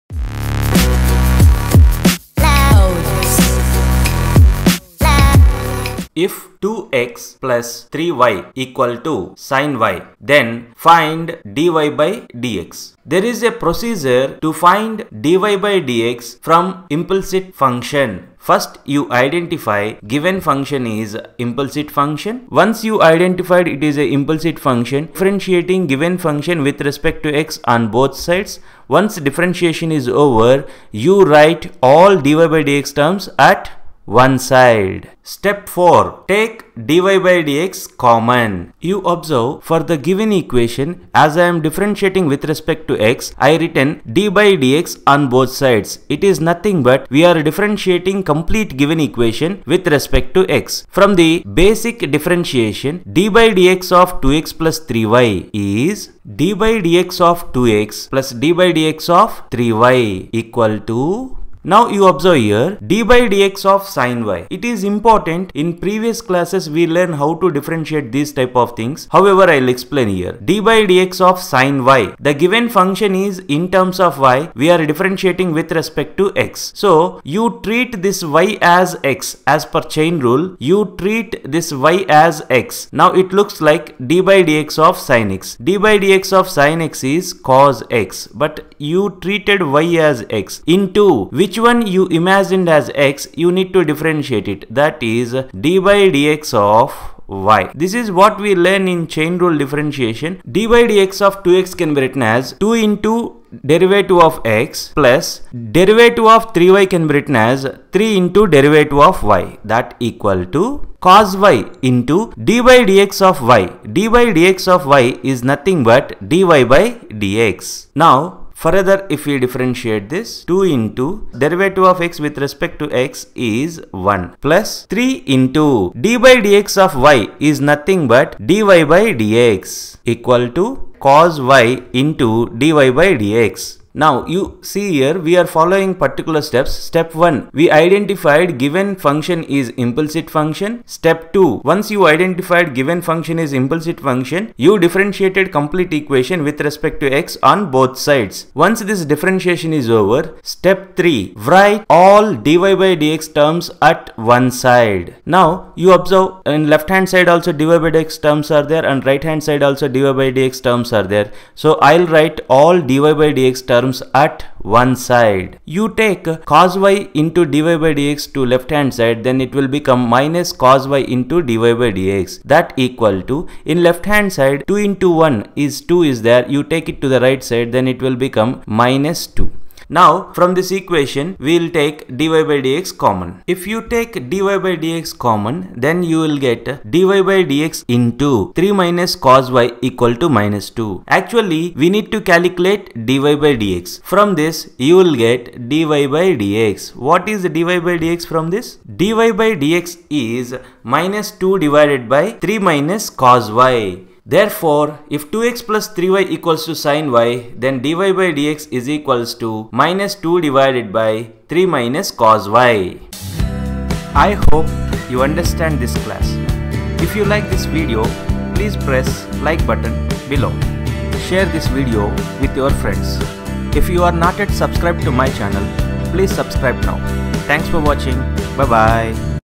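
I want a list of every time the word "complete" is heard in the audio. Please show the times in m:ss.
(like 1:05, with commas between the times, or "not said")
0:48, 2:25.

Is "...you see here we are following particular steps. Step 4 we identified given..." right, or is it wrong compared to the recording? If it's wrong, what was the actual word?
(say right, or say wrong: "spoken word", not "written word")
wrong: "1", not "4".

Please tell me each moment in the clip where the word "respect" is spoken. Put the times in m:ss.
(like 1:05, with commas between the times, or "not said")
0:26, 0:42, 0:49, 1:15, 2:02, 2:26.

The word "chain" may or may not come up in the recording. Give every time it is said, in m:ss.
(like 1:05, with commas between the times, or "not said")
1:19, 1:39.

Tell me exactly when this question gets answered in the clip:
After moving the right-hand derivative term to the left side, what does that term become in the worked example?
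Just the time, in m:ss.
2:50.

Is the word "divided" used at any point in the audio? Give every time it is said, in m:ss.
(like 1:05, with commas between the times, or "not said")
3:21, 3:30.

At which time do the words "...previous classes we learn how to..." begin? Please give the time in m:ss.
1:05.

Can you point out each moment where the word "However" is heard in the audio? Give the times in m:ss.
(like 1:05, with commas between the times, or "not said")
1:09.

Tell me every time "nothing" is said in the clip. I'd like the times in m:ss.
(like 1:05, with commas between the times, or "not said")
0:46, 1:55, 2:07.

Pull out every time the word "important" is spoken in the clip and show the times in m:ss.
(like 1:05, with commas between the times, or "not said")
1:04.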